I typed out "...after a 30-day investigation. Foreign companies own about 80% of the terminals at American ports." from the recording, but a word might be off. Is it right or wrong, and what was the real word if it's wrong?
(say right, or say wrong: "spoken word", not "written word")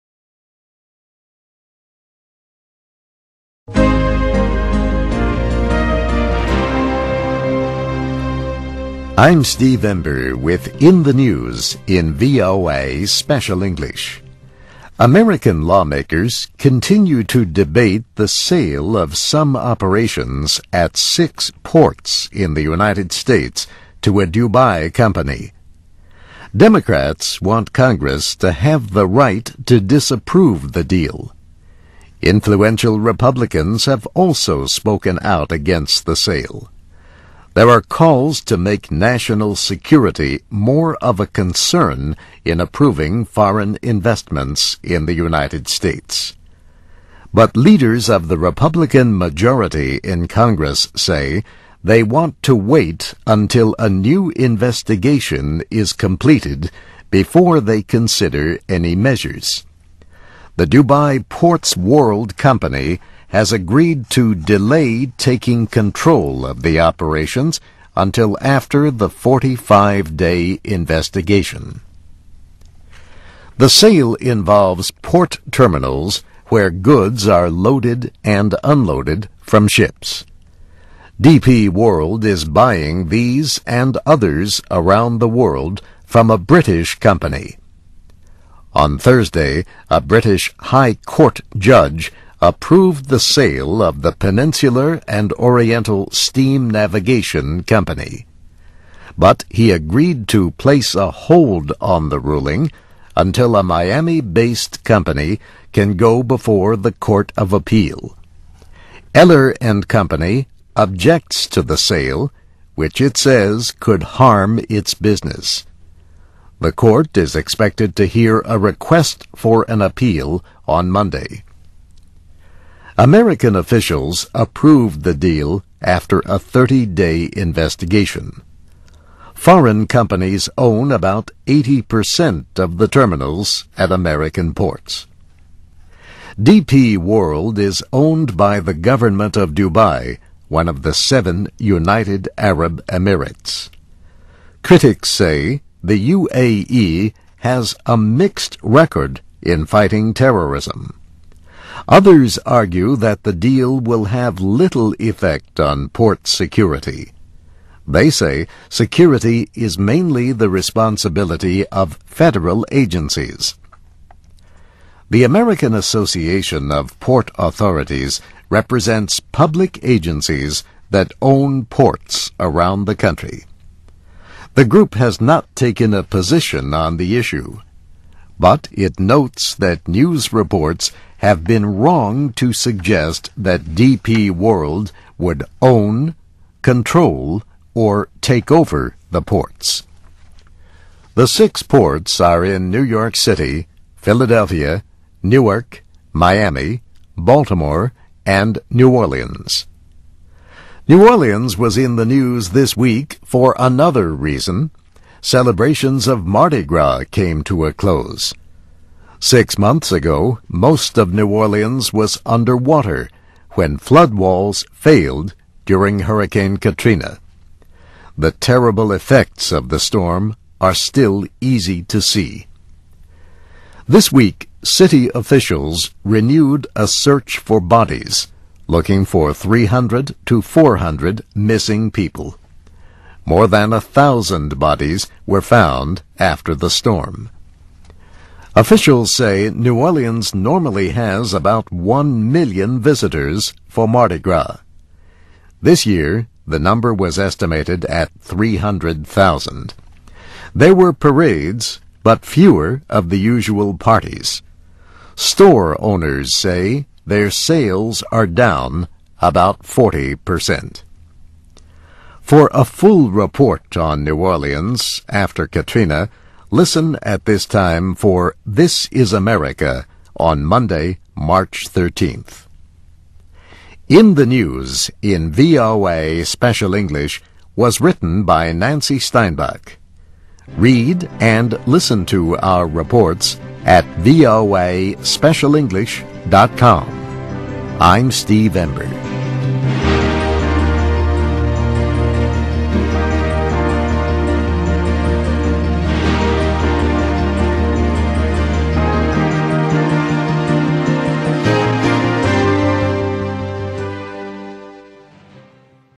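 right.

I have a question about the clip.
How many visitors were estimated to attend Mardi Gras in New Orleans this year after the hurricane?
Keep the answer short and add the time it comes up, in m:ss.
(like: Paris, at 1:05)
300,000, at 4:08.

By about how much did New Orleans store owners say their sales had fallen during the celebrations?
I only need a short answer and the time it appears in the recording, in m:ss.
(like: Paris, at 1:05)
40%, at 4:19.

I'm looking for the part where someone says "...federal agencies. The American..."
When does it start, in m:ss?
2:42.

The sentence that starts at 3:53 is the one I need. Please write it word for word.
More than a thousand bodies were found after the storm.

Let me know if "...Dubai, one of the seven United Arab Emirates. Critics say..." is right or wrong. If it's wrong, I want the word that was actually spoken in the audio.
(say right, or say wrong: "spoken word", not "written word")
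right.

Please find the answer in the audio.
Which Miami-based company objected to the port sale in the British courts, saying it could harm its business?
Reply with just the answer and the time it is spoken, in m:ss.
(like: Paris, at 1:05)
Eller and Company, at 1:49.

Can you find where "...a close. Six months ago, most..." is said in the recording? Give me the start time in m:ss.
3:27.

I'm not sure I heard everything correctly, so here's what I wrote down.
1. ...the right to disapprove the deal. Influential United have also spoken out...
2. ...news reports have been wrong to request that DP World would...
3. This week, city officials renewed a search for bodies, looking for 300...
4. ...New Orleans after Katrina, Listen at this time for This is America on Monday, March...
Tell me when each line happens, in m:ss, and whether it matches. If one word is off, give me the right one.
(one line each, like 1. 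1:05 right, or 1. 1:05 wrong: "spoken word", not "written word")
1. 0:28 wrong: "Republicans", not "United"
2. 2:59 wrong: "suggest", not "request"
3. 3:43 right
4. 4:24 right.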